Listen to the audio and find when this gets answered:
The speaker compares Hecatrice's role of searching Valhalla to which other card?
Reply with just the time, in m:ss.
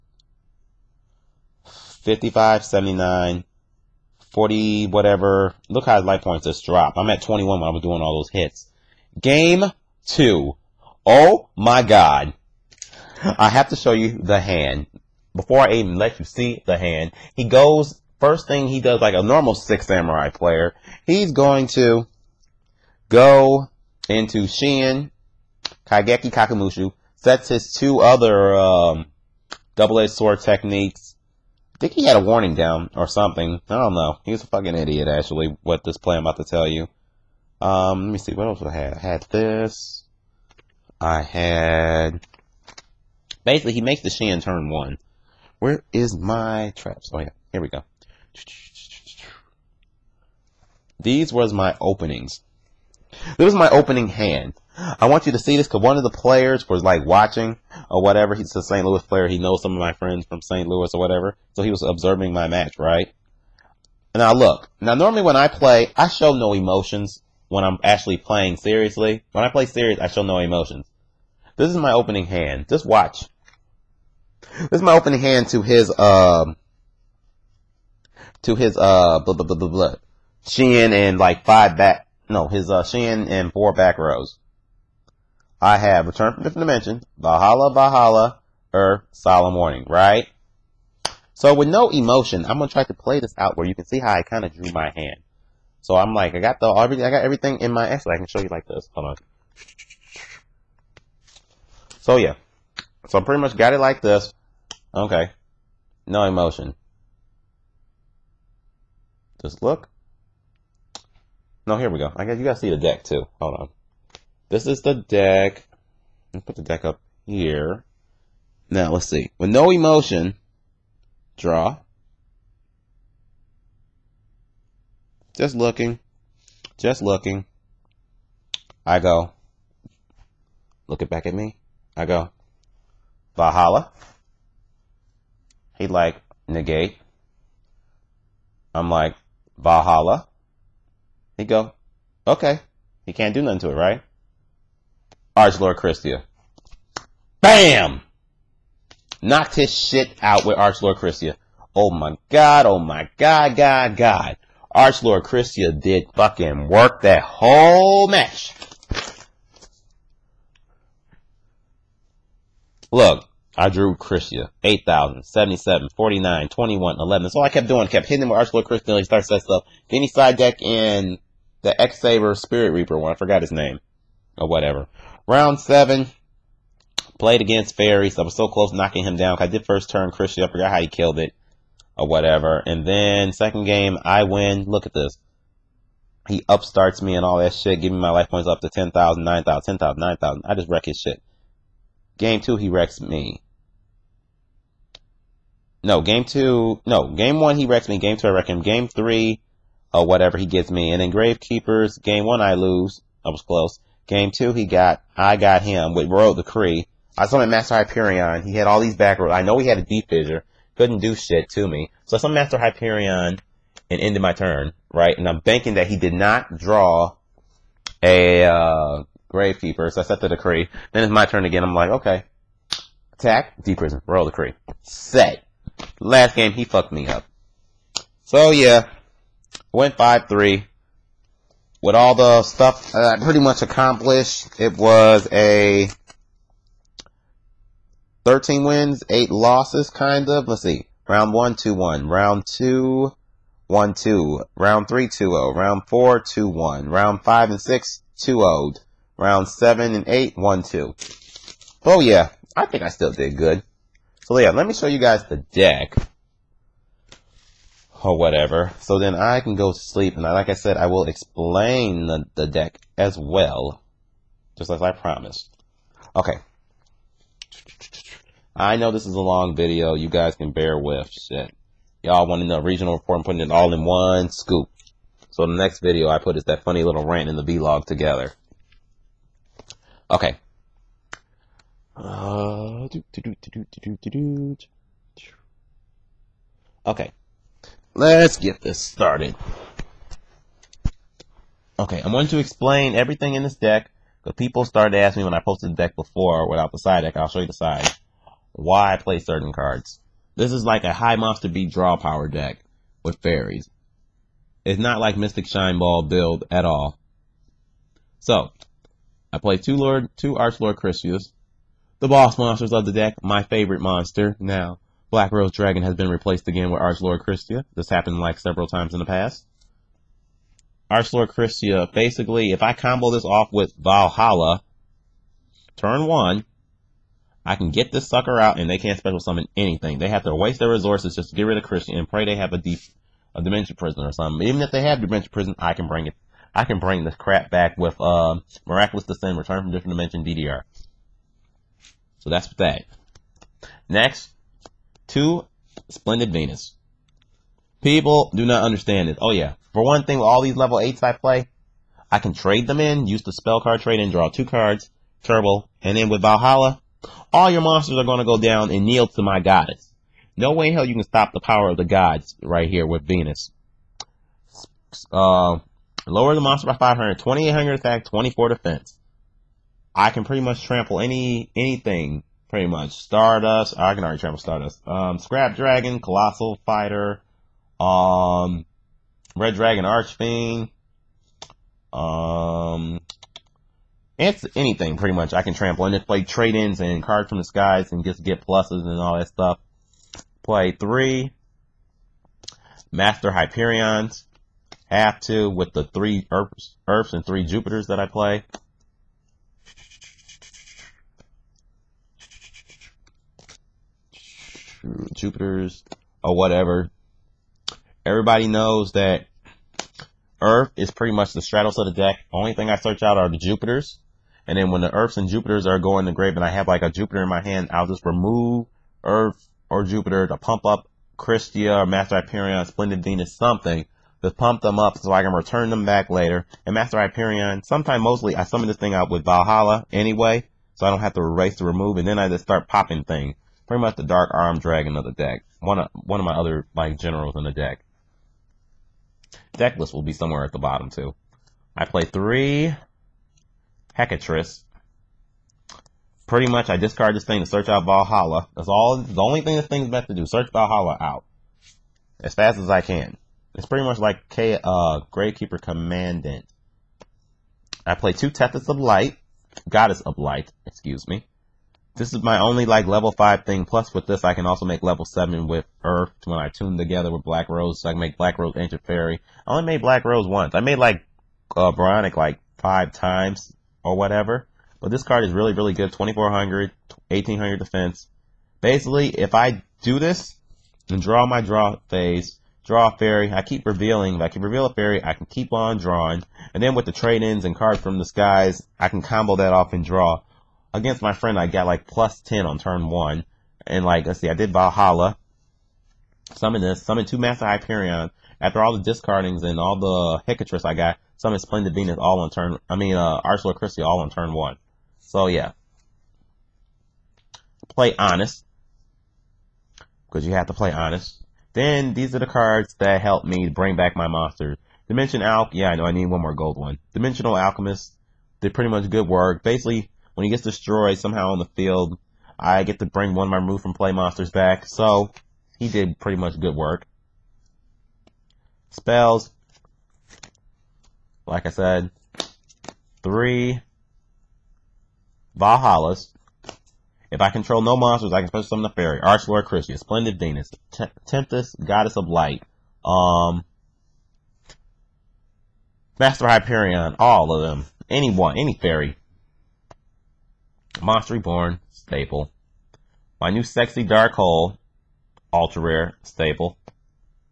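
7:35.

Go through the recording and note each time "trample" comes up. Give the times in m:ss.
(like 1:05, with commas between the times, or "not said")
6:10, 6:25.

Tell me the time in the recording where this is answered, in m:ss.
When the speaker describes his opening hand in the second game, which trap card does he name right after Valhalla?
1:29.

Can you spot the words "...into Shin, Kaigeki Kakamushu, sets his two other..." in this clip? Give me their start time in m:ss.
0:24.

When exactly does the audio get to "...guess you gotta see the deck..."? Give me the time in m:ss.
1:52.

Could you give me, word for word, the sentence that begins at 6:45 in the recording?
Jupiter's or whatever, everybody knows that Earth is pretty much the straddles of the deck.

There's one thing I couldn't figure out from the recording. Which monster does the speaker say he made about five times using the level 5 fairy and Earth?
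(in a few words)
Brionac.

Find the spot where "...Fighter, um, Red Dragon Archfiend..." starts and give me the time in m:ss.
6:16.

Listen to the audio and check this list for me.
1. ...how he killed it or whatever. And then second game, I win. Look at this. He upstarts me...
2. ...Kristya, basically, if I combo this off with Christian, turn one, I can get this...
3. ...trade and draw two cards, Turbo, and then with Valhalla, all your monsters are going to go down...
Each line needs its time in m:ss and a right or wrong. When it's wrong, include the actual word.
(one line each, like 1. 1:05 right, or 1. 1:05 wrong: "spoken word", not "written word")
1. 3:00 right
2. 5:21 wrong: "Valhalla", not "Christian"
3. 5:53 right.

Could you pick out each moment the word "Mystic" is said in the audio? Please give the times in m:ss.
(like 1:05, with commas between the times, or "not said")
5:05.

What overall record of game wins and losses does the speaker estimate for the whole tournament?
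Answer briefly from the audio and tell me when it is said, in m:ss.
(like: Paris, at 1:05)
13 wins, 8 losses, at 3:58.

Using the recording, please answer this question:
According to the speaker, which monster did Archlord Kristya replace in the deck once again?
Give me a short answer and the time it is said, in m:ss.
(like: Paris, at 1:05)
Black Rose Dragon, at 5:15.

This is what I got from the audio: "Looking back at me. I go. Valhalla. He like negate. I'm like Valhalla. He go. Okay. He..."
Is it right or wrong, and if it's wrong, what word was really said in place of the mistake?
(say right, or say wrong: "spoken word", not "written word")
right.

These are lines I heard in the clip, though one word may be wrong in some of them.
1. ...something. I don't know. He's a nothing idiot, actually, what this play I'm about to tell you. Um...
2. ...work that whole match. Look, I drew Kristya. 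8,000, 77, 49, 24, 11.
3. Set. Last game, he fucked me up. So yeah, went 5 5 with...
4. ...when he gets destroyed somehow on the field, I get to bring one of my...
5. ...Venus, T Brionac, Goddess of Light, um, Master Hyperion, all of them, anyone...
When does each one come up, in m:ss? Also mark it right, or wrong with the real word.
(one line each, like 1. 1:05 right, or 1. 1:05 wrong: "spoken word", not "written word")
1. 0:33 wrong: "fucking", not "nothing"
2. 2:36 wrong: "21", not "24"
3. 3:44 wrong: "3", not "5"
4. 8:40 right
5. 9:00 wrong: "Tempest", not "Brionac".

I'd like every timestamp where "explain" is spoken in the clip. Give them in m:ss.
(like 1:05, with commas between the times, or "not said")
4:21, 4:52.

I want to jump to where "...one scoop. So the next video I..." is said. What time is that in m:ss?
4:33.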